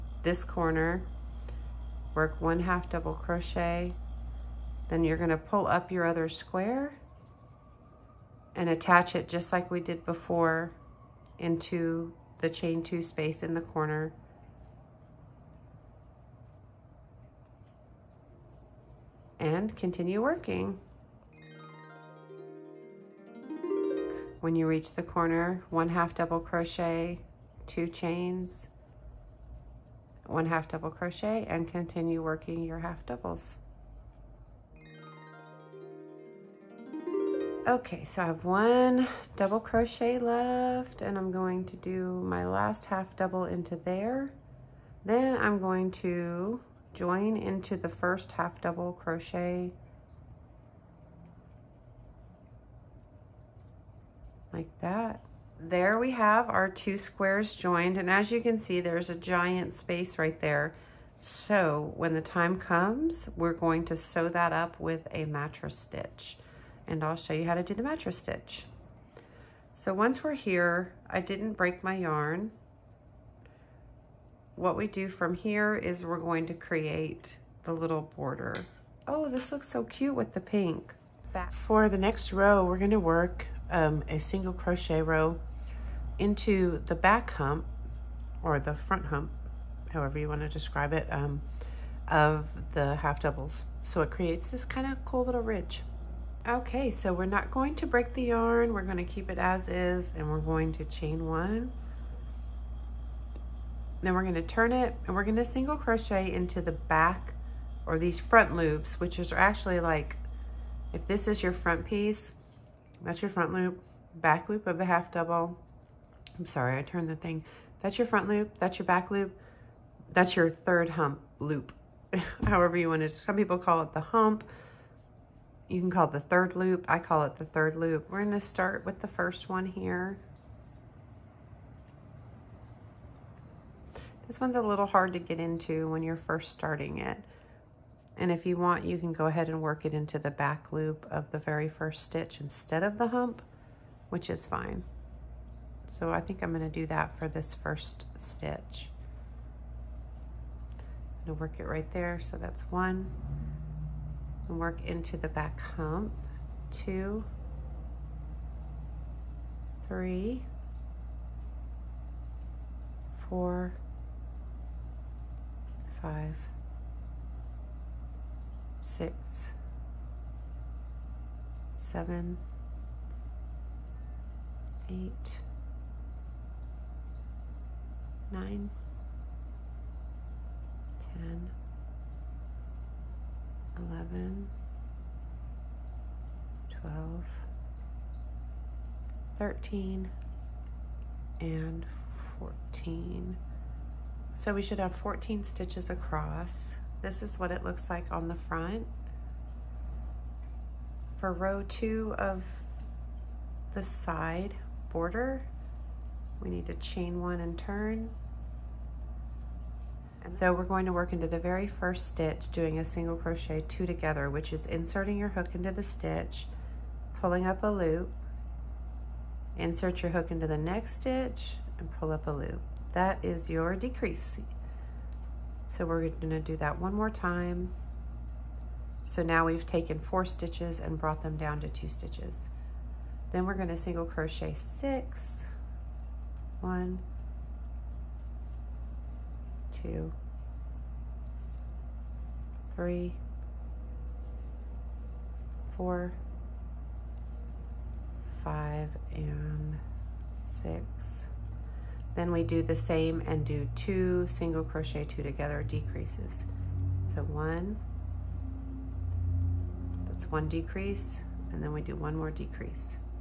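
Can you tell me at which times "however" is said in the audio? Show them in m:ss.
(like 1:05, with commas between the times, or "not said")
1:29, 2:02.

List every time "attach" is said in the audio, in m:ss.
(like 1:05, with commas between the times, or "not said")
0:08.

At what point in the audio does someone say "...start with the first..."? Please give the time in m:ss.
2:08.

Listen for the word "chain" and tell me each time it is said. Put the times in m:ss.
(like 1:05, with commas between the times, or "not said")
0:12, 0:27, 1:40, 3:26.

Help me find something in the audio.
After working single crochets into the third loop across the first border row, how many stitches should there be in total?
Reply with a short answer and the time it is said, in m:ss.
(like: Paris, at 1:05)
14, at 3:14.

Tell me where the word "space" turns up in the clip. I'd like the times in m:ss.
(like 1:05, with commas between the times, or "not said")
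0:13, 0:59.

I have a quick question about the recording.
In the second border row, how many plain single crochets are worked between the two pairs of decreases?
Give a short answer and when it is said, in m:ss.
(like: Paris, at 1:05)
6, at 3:53.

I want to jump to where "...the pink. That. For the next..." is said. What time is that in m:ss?
1:20.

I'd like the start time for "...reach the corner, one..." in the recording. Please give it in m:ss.
0:24.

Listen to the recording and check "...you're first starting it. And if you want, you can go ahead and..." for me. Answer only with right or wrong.
right.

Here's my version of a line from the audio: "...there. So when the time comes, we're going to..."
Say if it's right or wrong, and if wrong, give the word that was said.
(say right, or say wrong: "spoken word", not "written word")
right.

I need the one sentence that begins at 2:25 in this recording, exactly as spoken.
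So I think I'm gonna do that for this first stitch.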